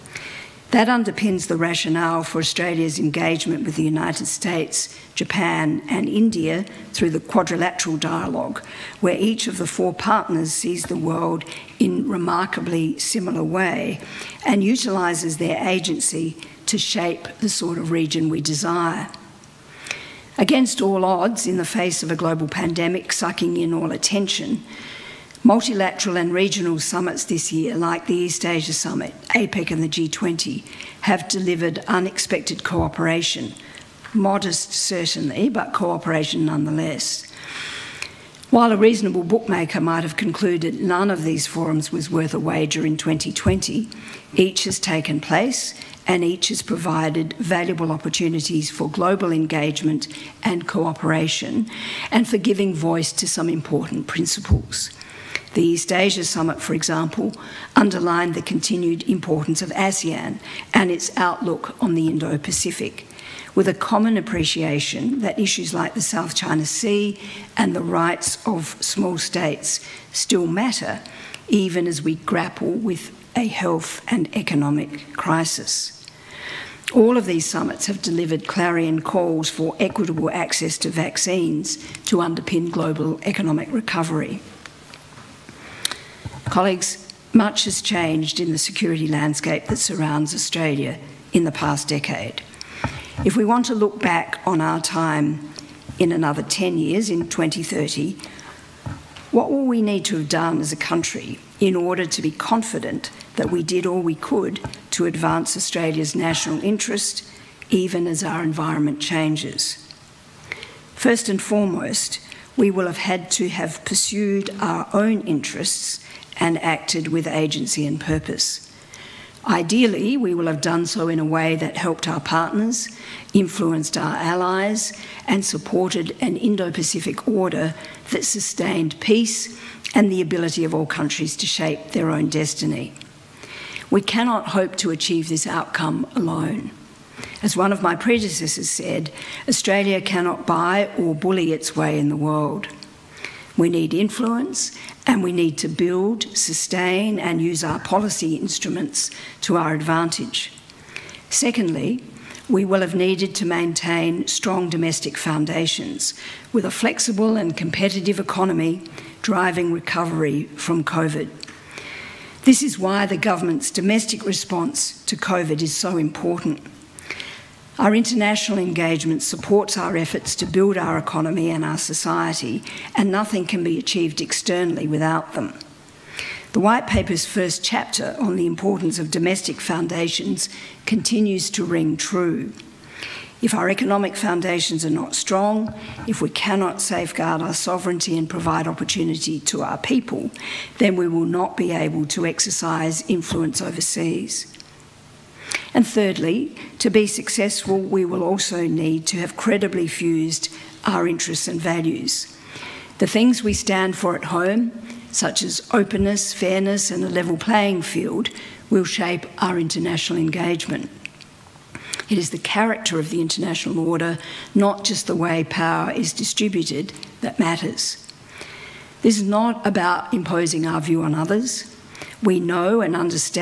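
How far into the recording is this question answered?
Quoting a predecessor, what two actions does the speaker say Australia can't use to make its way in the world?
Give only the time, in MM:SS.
02:20.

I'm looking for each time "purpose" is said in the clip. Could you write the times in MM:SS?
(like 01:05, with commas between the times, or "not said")
01:57.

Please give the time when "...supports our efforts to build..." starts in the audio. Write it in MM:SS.
02:49.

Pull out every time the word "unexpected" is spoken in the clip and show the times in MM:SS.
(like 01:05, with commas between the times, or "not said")
00:31.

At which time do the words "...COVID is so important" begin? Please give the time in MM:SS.
02:45.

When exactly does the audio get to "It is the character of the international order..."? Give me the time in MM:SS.
03:32.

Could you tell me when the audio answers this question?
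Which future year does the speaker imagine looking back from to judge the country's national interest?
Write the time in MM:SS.
01:37.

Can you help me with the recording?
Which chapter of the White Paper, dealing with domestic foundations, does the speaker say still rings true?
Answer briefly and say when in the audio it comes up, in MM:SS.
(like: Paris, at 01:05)
first chapter, at 02:57.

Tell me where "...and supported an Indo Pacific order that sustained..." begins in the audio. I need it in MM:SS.
02:05.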